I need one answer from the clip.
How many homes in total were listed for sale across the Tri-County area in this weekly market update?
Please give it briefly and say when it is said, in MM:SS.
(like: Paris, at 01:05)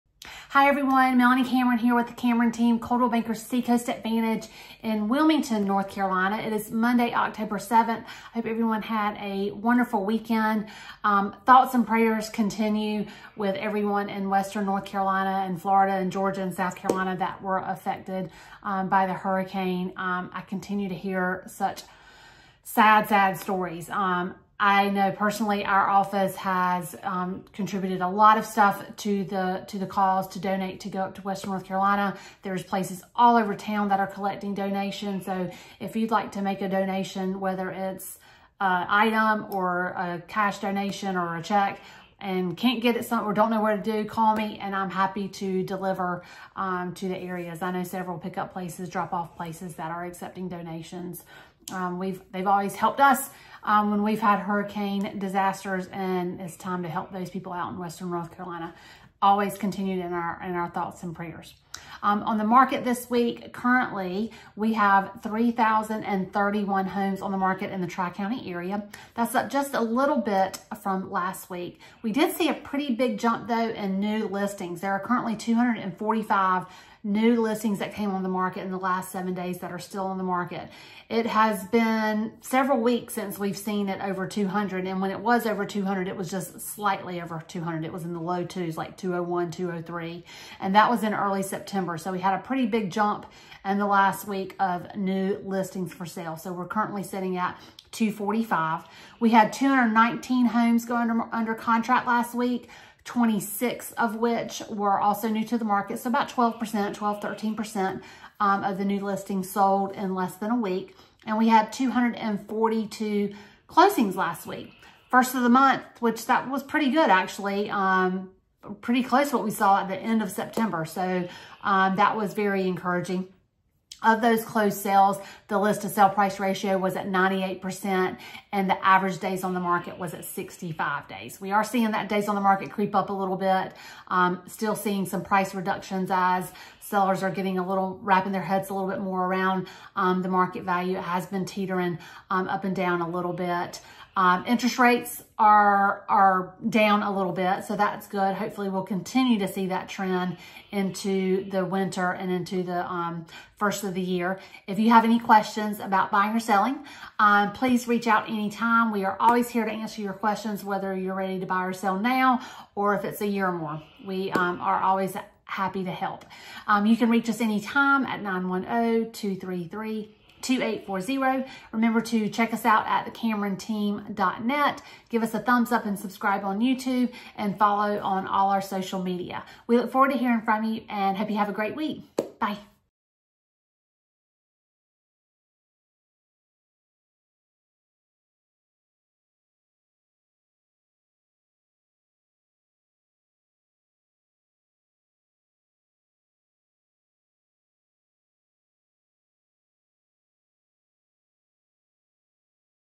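3,031, at 01:05.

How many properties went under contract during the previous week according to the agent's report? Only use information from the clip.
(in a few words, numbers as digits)
219.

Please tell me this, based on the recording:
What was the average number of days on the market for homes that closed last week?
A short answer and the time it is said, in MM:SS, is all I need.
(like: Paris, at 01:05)
65 days, at 02:10.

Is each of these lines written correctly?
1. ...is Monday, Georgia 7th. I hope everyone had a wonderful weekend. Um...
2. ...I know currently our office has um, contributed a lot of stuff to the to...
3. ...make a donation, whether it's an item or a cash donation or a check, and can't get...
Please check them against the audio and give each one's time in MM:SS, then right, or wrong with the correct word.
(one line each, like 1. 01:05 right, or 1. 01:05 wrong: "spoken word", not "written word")
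1. 00:06 wrong: "October", not "Georgia"
2. 00:24 wrong: "personally", not "currently"
3. 00:36 right.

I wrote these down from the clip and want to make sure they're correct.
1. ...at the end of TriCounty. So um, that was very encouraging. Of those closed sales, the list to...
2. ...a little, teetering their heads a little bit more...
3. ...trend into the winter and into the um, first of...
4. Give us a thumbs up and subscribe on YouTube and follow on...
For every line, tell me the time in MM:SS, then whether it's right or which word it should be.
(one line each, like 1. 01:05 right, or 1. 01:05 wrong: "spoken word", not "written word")
1. 01:59 wrong: "September", not "TriCounty"
2. 02:17 wrong: "wrapping", not "teetering"
3. 02:29 right
4. 02:55 right.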